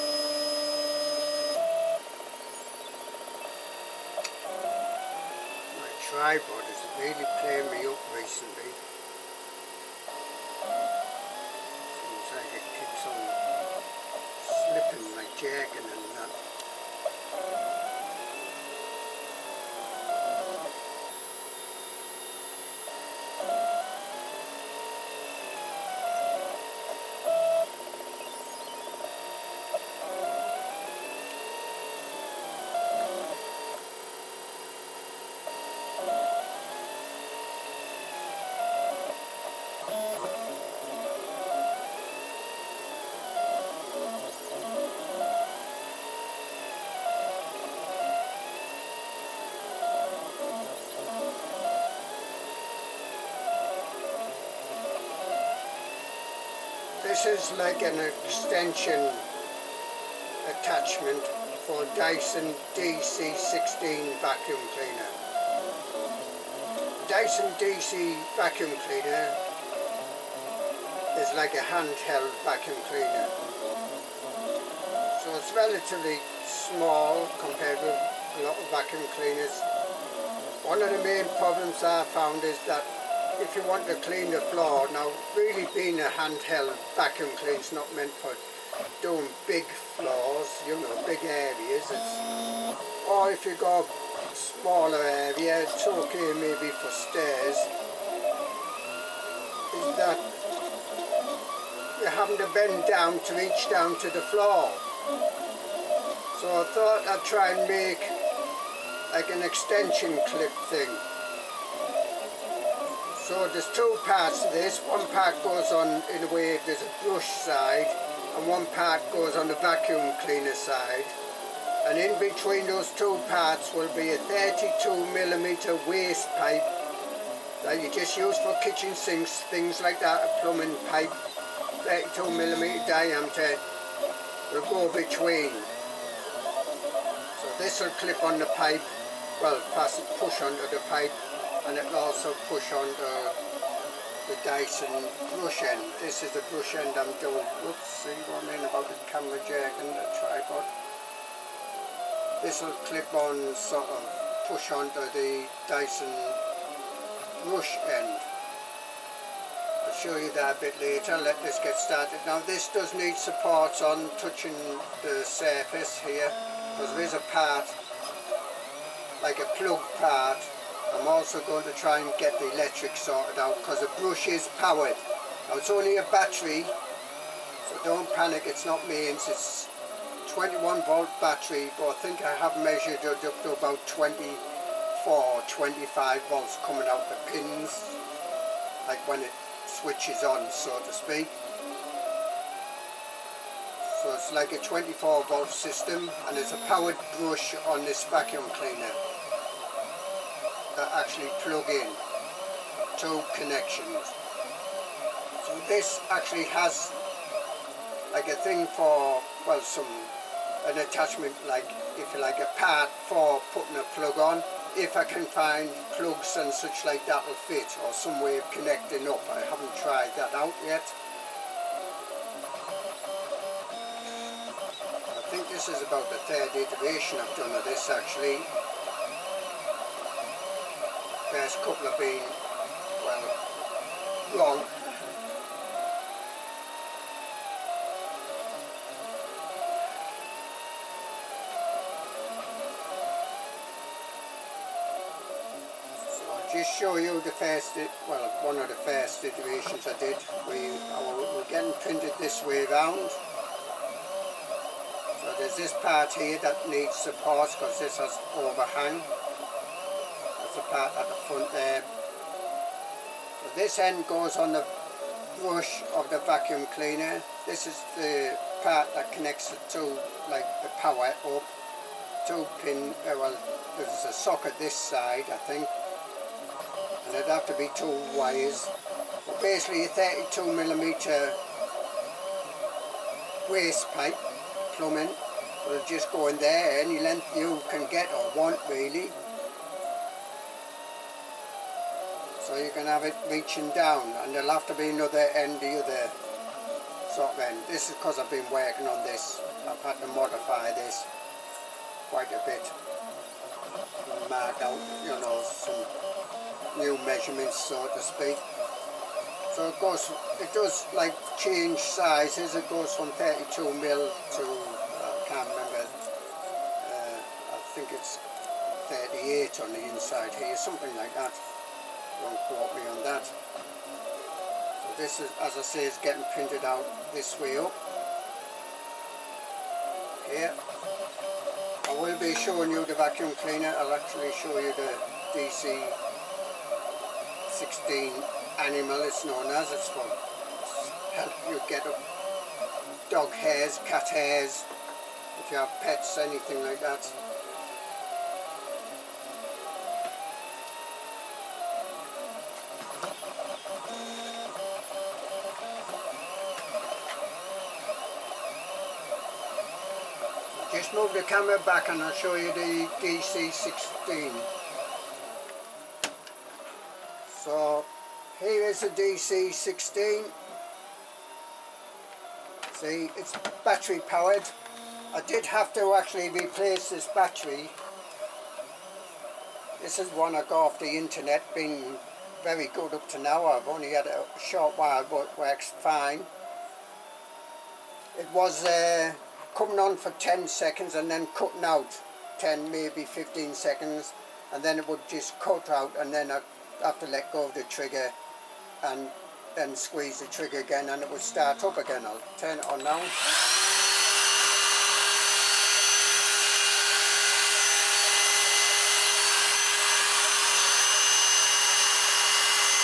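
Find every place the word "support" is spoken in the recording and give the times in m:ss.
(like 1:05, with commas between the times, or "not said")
2:43, 4:16.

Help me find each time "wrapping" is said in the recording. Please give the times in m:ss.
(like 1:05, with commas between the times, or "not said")
not said.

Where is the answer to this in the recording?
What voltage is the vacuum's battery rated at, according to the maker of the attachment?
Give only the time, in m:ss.
3:00.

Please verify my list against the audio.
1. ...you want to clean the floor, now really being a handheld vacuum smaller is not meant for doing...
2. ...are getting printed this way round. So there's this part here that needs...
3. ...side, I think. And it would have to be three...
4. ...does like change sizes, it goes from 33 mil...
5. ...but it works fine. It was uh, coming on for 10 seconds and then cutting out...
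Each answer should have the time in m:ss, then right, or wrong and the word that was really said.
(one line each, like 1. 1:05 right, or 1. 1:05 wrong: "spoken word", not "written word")
1. 1:23 wrong: "cleaner", not "smaller"
2. 4:10 right
3. 4:34 wrong: "two", not "three"
4. 5:10 wrong: "32", not "33"
5. 6:25 right.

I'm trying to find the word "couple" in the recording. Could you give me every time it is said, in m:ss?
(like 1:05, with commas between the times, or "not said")
3:51.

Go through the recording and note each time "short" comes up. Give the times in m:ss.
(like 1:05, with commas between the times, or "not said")
6:24.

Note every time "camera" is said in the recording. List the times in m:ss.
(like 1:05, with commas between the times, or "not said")
2:29, 6:01.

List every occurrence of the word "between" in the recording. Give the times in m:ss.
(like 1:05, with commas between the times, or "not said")
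2:02, 2:14.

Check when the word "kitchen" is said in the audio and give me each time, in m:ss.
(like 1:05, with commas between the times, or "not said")
2:08.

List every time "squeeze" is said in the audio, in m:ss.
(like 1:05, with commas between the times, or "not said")
6:39.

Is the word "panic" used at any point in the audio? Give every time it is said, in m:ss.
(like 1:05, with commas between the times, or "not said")
2:58.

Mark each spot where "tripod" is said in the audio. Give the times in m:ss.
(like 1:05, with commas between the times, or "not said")
0:06, 2:30.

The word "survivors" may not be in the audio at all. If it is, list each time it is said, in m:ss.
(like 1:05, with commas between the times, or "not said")
not said.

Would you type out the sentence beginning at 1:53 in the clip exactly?
So there's two parts to this.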